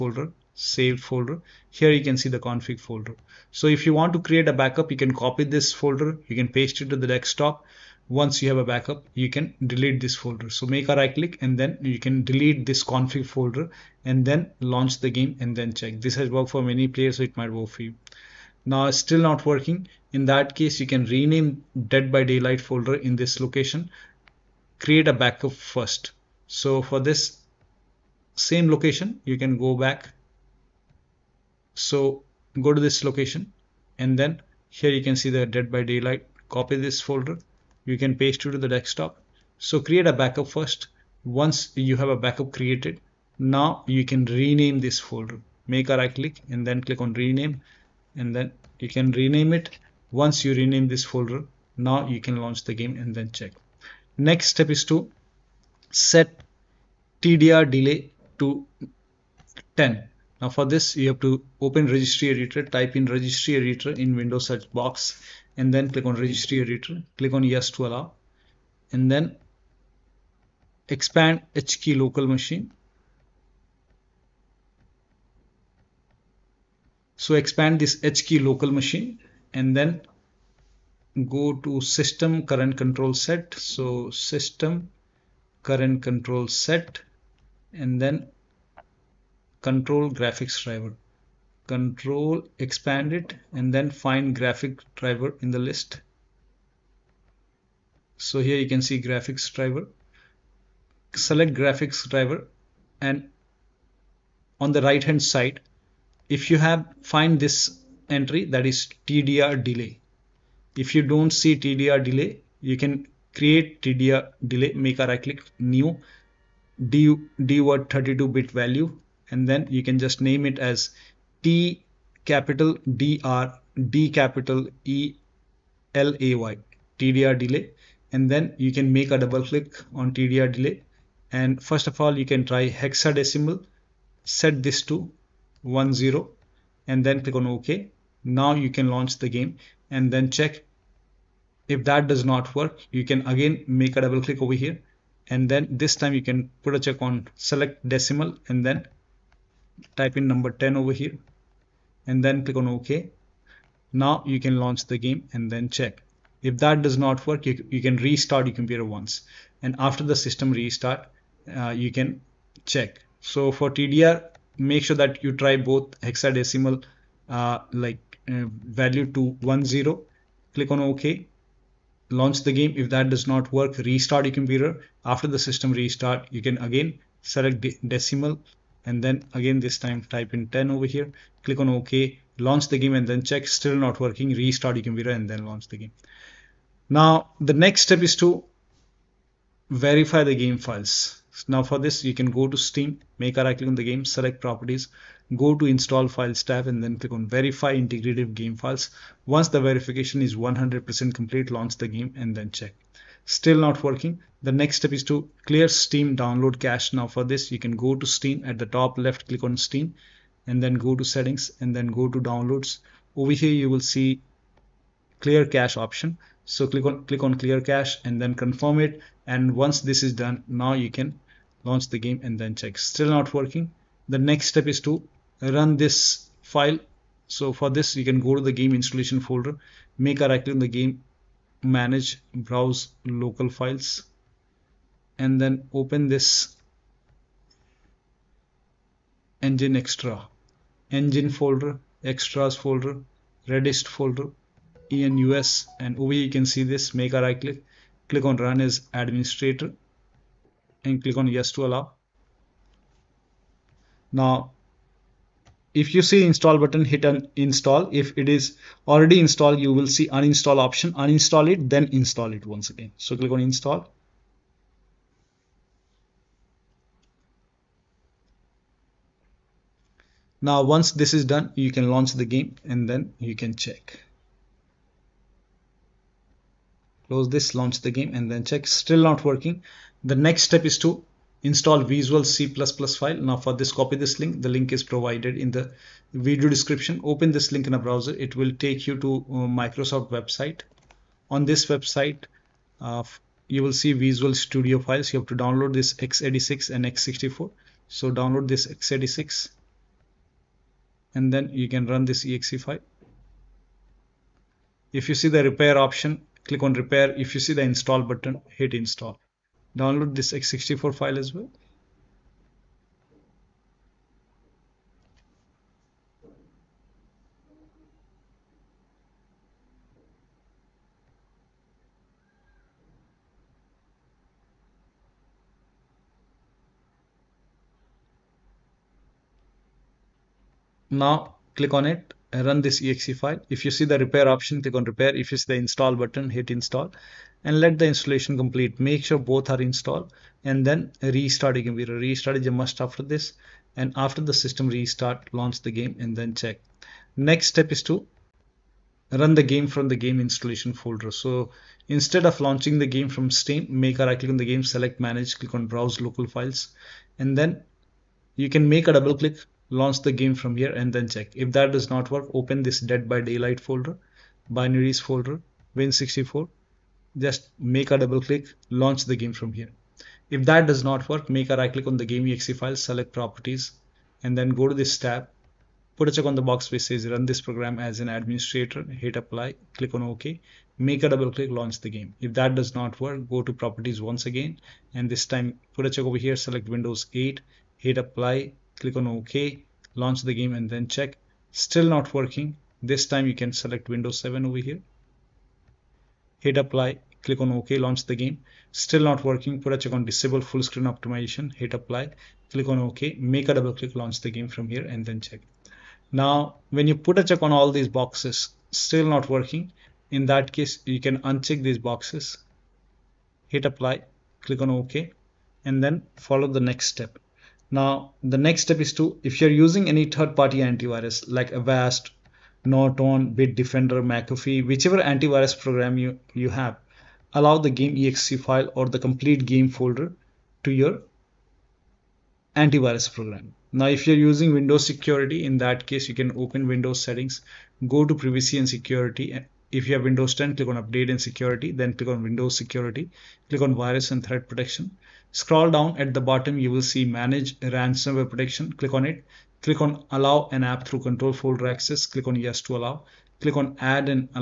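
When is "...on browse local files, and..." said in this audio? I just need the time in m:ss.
5:55.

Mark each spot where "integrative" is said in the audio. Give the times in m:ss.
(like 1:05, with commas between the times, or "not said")
3:17.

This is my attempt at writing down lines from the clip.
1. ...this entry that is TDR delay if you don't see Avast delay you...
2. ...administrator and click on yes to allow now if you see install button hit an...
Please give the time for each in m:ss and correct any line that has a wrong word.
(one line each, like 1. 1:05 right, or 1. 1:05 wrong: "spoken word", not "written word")
1. 1:47 wrong: "TDR", not "Avast"
2. 4:08 right.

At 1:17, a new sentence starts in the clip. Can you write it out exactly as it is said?
So expand this HKey local machine and then go to system current control set.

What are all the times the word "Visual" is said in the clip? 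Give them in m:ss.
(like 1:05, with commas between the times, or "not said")
4:41, 4:53.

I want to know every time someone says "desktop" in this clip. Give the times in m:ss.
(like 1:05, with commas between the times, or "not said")
0:07, 0:38.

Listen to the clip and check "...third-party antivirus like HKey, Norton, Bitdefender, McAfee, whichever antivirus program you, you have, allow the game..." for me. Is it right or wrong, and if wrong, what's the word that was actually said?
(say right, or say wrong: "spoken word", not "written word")
wrong: "Avast", not "HKey".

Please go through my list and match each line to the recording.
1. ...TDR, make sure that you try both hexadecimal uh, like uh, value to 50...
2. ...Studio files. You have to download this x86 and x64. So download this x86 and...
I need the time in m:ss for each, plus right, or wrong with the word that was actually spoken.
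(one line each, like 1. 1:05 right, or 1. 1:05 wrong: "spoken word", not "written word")
1. 2:43 wrong: "10", not "50"
2. 4:54 right.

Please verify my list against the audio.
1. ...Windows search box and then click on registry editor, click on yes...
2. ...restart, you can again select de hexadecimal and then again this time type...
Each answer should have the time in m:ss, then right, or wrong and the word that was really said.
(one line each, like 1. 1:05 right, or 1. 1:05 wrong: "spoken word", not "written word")
1. 1:04 right
2. 2:55 wrong: "decimal", not "hexadecimal".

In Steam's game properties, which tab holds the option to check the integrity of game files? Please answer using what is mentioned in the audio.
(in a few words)
Install files.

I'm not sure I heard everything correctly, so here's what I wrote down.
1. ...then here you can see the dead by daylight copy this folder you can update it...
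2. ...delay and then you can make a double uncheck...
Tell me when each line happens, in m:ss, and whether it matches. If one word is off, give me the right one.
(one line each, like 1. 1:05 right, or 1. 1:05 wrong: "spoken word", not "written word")
1. 0:34 wrong: "paste", not "update"
2. 2:07 wrong: "click", not "uncheck".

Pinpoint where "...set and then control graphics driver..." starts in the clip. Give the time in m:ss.
1:26.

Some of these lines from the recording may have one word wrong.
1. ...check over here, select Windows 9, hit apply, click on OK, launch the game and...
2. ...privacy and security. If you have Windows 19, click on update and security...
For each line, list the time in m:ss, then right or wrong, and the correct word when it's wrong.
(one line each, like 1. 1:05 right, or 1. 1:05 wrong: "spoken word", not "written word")
1. 6:25 wrong: "8", not "9"
2. 7:18 wrong: "10", not "19".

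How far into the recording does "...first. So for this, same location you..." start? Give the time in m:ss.
0:25.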